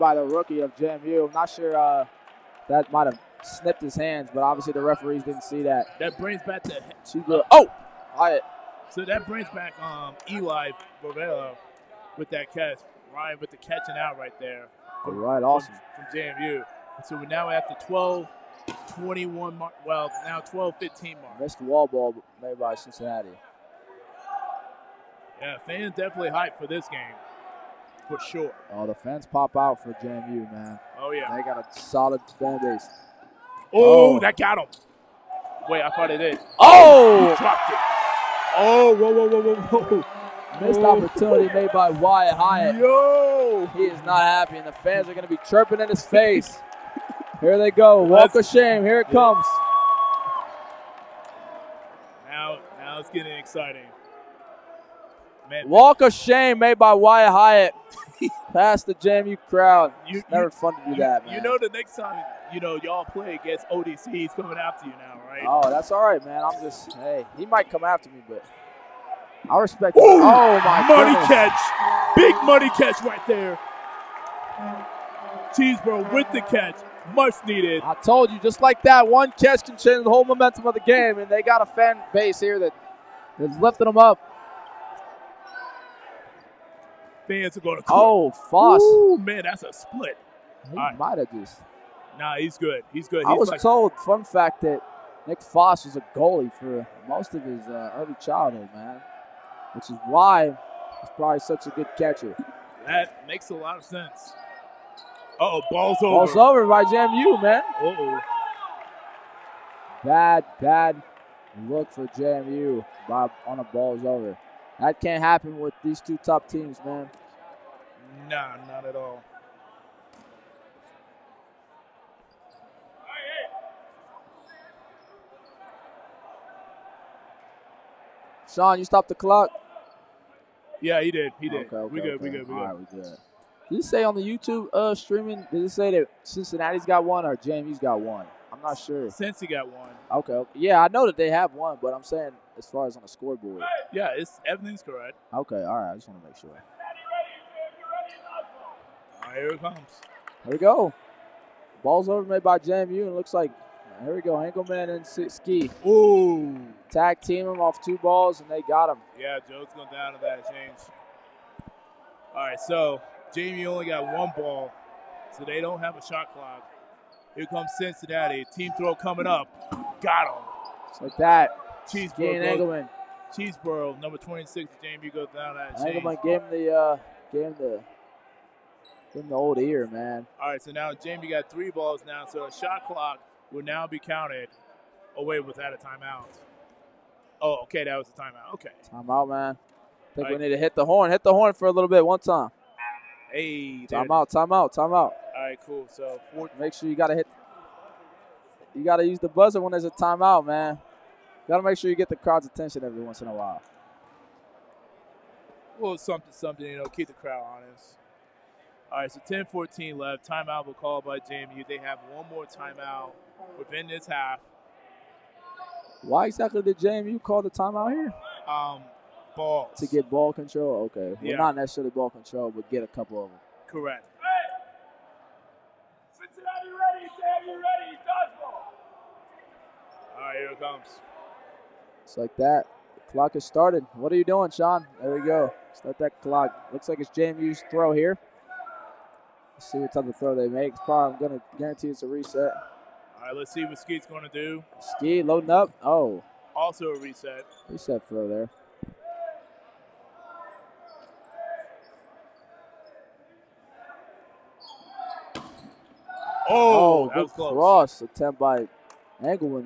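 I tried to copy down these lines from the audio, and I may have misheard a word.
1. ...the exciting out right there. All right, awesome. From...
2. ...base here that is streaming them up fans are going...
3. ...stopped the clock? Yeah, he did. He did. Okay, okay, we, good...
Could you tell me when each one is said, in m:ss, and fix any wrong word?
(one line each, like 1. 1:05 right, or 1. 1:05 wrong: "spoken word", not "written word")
1. 0:13 wrong: "catching", not "exciting"
2. 1:22 wrong: "lifting", not "streaming"
3. 2:08 right.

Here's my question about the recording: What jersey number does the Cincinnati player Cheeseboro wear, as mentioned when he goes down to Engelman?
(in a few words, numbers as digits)
26.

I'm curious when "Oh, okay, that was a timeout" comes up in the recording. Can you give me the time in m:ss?
3:07.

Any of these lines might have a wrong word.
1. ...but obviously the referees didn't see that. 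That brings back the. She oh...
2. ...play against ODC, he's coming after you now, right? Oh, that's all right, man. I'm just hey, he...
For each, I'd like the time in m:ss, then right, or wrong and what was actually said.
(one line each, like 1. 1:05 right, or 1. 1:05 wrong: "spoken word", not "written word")
1. 0:04 right
2. 1:03 right.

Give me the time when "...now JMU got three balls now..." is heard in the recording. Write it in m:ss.
3:00.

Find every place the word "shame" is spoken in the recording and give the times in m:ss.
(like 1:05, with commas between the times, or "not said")
0:48, 0:56.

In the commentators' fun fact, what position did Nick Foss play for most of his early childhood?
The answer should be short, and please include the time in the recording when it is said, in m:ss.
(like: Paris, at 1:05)
goalie, at 1:36.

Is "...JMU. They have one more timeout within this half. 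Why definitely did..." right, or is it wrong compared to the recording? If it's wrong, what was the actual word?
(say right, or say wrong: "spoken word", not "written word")
wrong: "exactly", not "definitely".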